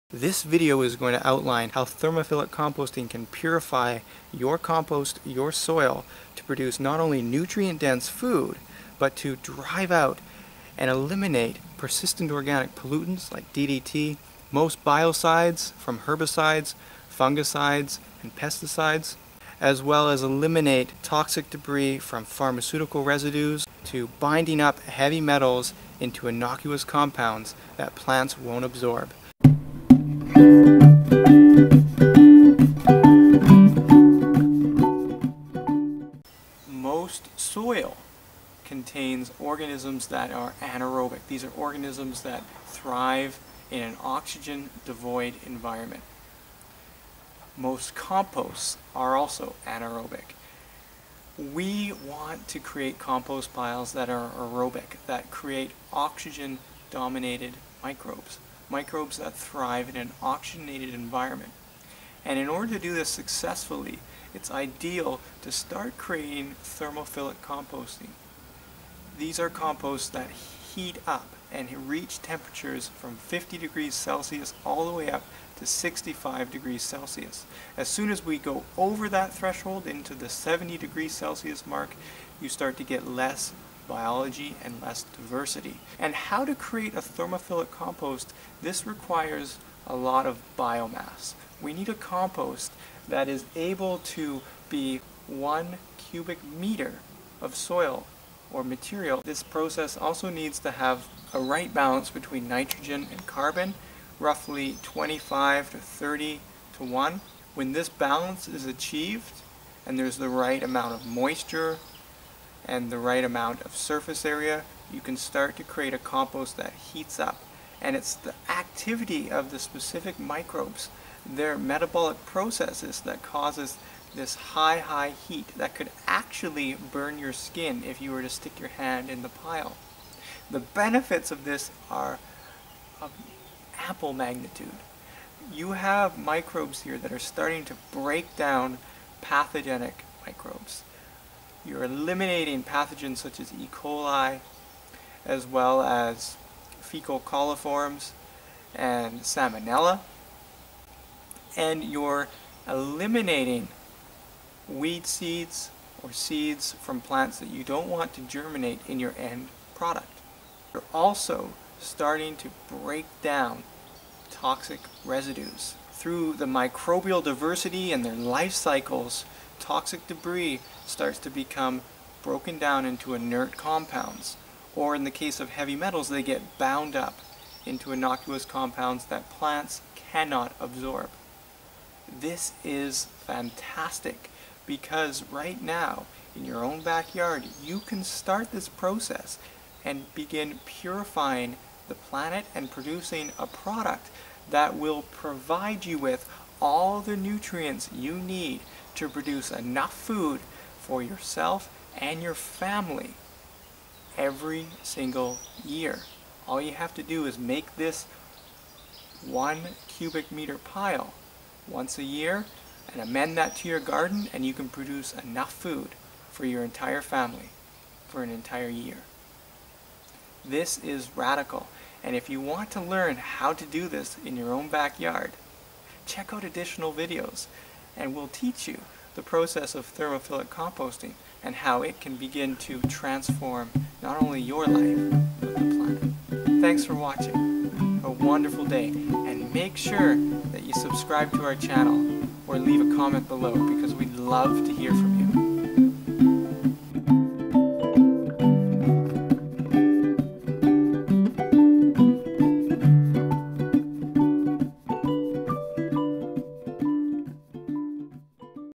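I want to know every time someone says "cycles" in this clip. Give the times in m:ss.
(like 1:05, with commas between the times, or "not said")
2:48.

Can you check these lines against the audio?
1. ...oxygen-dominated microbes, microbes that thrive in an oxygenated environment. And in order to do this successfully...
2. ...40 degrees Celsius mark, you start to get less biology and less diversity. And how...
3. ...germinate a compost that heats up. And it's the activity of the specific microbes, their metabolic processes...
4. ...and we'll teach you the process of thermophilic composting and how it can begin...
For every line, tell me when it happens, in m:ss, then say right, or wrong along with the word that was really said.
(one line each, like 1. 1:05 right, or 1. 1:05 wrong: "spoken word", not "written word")
1. 0:55 right
2. 1:20 wrong: "70", not "40"
3. 1:55 wrong: "create", not "germinate"
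4. 3:47 right.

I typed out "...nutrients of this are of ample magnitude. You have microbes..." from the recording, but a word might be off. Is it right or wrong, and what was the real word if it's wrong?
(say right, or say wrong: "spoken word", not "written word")
wrong: "benefits", not "nutrients".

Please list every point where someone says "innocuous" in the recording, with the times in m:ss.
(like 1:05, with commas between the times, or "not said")
0:26, 2:57.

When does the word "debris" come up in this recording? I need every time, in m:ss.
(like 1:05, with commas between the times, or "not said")
0:21, 2:50.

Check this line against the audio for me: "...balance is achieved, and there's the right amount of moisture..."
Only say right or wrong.
right.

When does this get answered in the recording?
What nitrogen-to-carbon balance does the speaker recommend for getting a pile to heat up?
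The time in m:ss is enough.
1:44.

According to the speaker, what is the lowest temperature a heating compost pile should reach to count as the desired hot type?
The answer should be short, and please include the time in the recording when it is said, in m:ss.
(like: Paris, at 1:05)
50 degrees Celsius, at 1:13.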